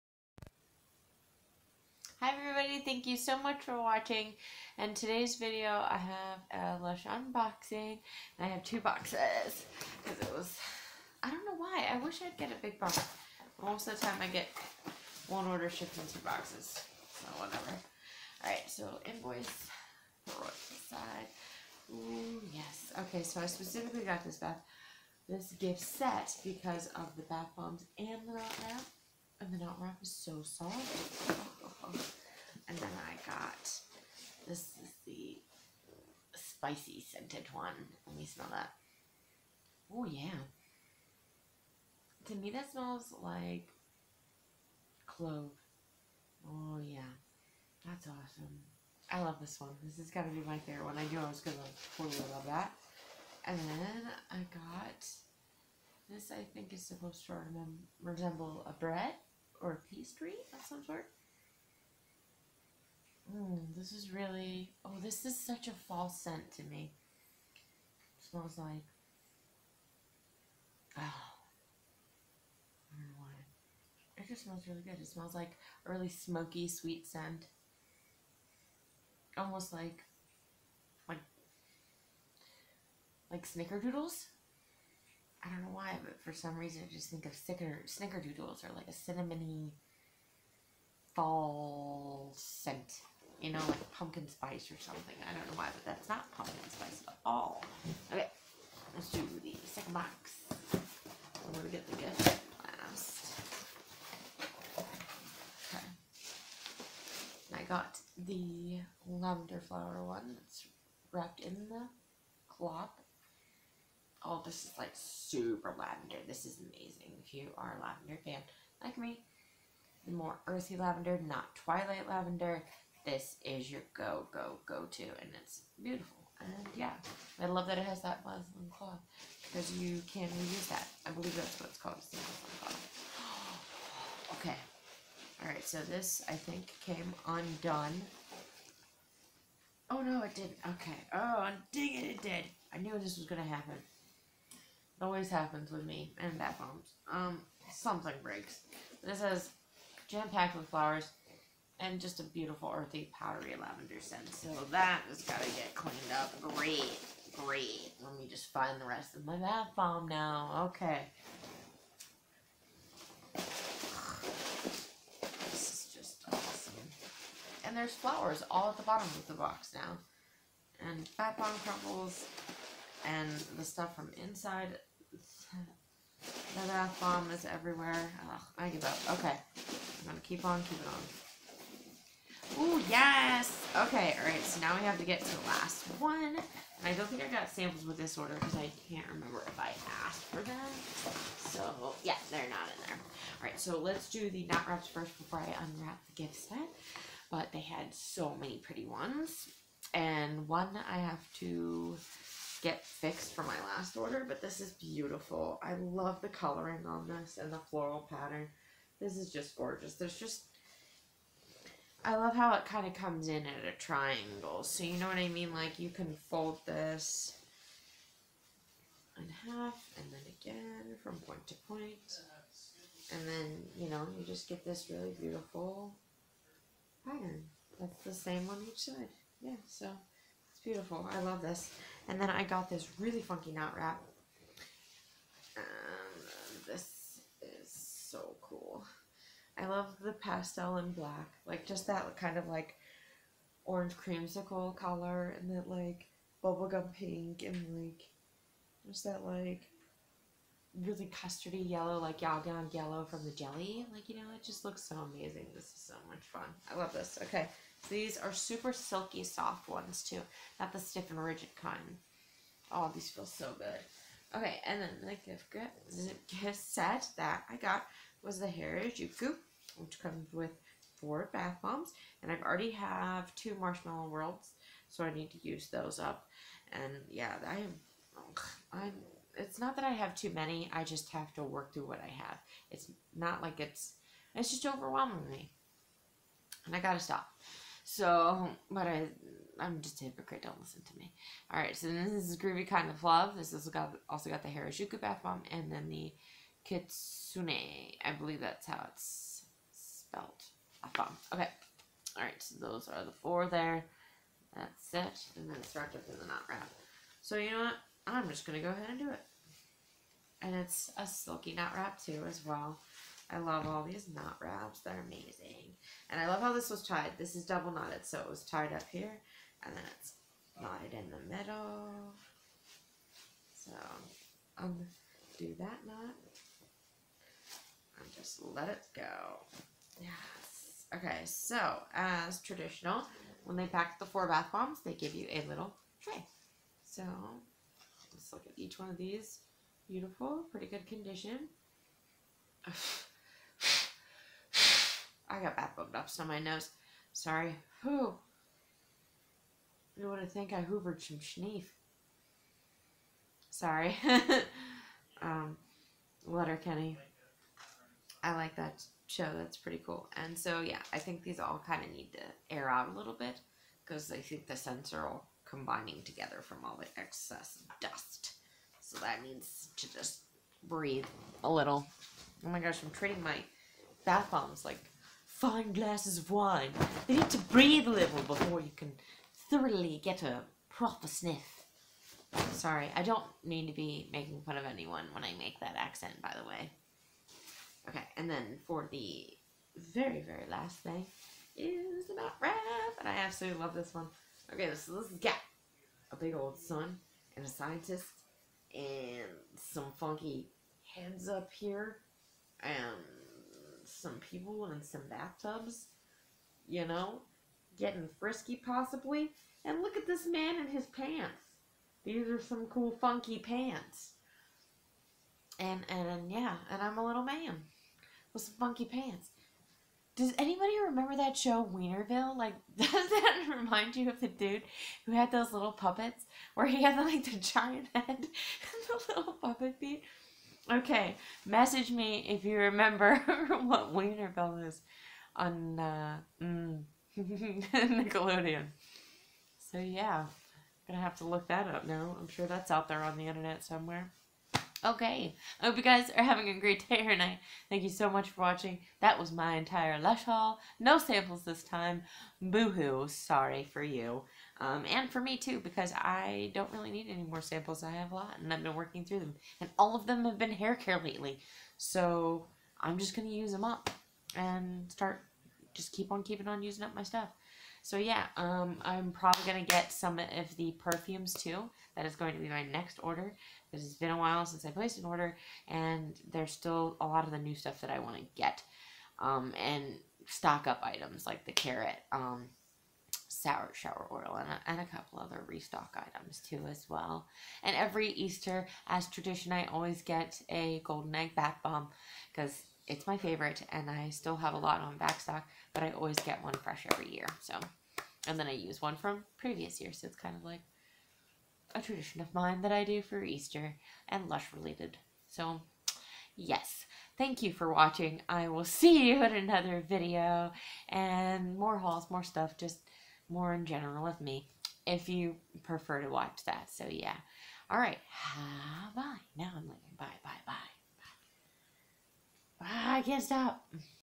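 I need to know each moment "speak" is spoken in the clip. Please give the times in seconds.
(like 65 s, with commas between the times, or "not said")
not said.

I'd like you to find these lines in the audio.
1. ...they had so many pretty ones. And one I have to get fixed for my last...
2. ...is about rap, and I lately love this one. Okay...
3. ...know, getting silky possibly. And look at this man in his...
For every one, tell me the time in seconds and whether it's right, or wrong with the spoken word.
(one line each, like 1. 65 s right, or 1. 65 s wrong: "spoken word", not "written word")
1. 197 s right
2. 391 s wrong: "absolutely", not "lately"
3. 406 s wrong: "frisky", not "silky".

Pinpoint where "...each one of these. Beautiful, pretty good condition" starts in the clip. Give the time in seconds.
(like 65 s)
338 s.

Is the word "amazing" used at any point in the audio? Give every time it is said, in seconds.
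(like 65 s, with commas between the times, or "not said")
116 s, 254 s, 315 s.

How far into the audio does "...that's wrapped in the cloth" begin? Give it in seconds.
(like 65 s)
110 s.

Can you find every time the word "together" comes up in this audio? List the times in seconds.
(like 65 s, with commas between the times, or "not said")
366 s.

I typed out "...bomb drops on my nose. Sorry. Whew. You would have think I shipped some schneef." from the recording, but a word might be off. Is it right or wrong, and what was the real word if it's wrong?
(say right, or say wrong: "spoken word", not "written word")
wrong: "hoovered", not "shipped".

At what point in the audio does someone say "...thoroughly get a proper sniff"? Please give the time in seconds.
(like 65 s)
379 s.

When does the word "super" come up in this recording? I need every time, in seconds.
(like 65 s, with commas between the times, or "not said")
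114 s, 258 s.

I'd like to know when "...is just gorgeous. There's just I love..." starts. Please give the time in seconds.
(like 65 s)
209 s.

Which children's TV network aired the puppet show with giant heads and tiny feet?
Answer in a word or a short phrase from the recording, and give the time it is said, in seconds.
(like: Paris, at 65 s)
Nickelodeon, at 437 s.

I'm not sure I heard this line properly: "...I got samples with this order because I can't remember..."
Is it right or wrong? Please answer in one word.
right.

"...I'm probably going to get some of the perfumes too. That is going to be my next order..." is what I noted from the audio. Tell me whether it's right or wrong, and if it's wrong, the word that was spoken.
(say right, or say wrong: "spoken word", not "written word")
right.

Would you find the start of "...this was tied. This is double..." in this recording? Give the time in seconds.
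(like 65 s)
316 s.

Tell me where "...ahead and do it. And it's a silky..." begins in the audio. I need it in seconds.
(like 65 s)
308 s.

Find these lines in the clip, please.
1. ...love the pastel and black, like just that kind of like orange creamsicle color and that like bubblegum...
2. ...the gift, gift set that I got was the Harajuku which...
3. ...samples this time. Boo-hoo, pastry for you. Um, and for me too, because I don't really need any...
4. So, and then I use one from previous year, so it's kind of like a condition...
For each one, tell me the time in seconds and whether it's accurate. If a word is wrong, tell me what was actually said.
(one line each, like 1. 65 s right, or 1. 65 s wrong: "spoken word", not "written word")
1. 239 s right
2. 265 s right
3. 450 s wrong: "sorry", not "pastry"
4. 497 s wrong: "tradition", not "condition".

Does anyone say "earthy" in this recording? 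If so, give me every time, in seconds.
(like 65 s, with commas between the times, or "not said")
120 s, 152 s.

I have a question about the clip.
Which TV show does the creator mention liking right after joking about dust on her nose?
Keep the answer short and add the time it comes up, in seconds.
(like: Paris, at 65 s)
Letterkenny, at 356 s.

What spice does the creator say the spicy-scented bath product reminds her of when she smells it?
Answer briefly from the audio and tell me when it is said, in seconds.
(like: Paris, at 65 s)
clove, at 45 s.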